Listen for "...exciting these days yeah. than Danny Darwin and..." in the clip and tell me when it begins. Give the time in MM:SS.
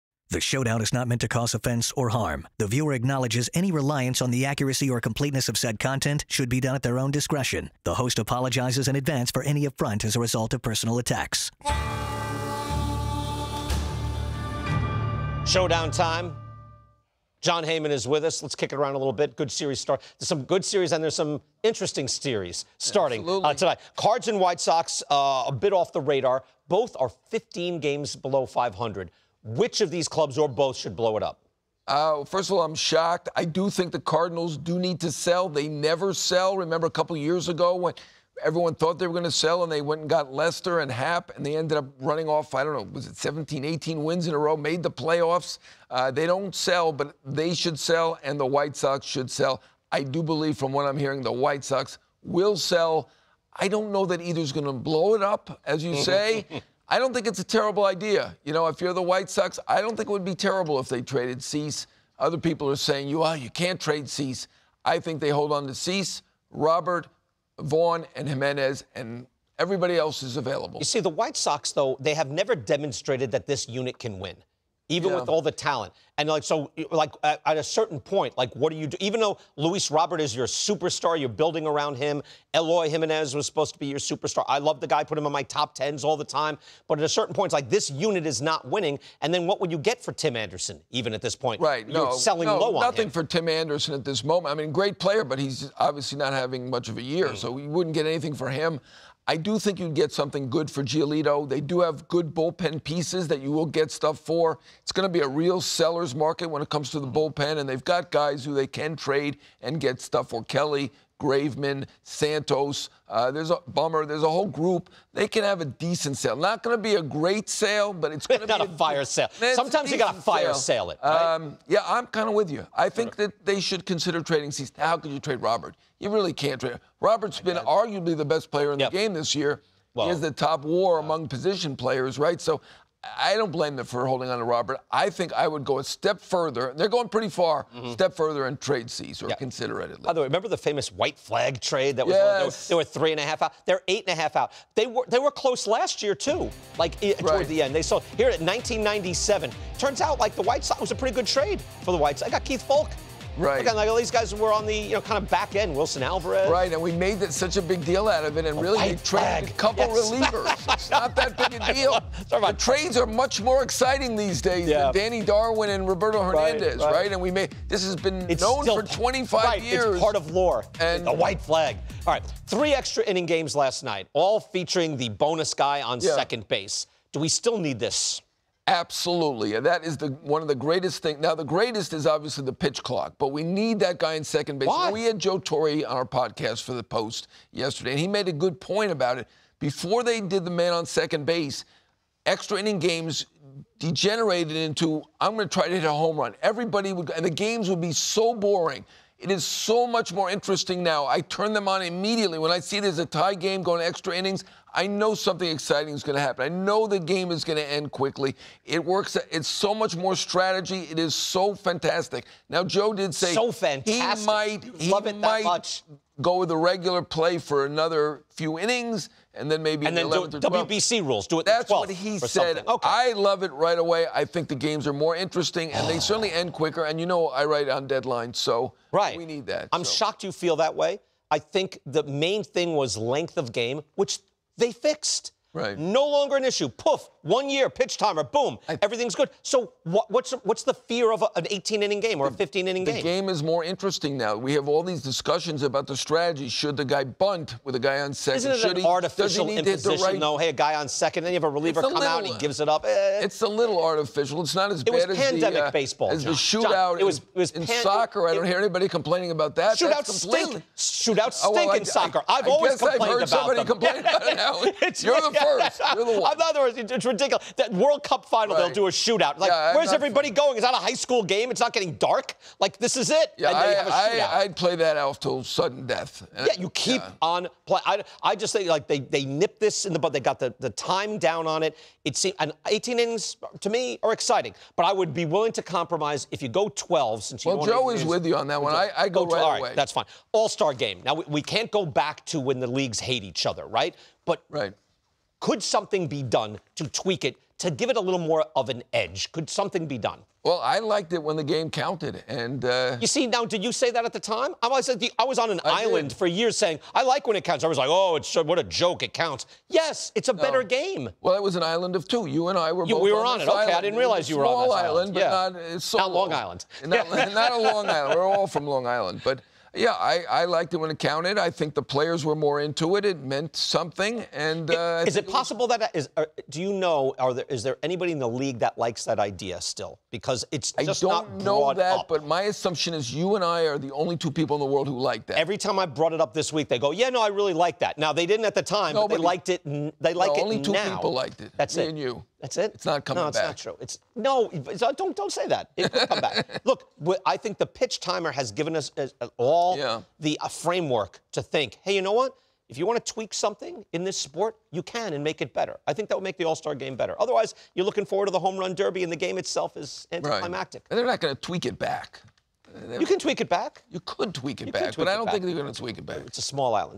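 02:43.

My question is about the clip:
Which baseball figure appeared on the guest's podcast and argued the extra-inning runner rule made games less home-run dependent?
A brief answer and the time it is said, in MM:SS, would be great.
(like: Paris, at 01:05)
Joe Torre, at 03:05.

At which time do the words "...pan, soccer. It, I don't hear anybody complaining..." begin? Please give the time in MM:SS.
04:17.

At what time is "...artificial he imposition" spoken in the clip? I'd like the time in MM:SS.
04:08.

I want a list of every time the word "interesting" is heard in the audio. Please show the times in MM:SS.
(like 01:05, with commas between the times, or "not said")
00:21, 03:20, 03:45, 04:03.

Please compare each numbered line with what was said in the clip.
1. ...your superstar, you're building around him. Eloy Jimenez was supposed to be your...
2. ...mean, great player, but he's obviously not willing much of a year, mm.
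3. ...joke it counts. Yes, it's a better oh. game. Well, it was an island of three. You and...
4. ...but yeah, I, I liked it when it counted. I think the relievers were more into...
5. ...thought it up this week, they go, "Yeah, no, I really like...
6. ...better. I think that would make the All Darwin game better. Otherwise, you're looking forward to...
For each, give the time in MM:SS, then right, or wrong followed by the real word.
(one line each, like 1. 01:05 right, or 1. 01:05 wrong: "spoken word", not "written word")
1. 01:20 right
2. 01:34 wrong: "having", not "willing"
3. 05:08 wrong: "two", not "three"
4. 05:19 wrong: "players", not "relievers"
5. 05:35 wrong: "brought", not "thought"
6. 05:55 wrong: "Star", not "Darwin".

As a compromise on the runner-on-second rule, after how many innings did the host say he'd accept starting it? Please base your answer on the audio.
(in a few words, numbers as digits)
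12.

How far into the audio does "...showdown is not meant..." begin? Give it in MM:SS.
00:00.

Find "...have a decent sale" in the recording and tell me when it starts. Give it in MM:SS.
01:55.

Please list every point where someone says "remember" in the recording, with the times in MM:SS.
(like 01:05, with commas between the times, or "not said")
00:36, 02:20.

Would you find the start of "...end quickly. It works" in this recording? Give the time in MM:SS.
03:27.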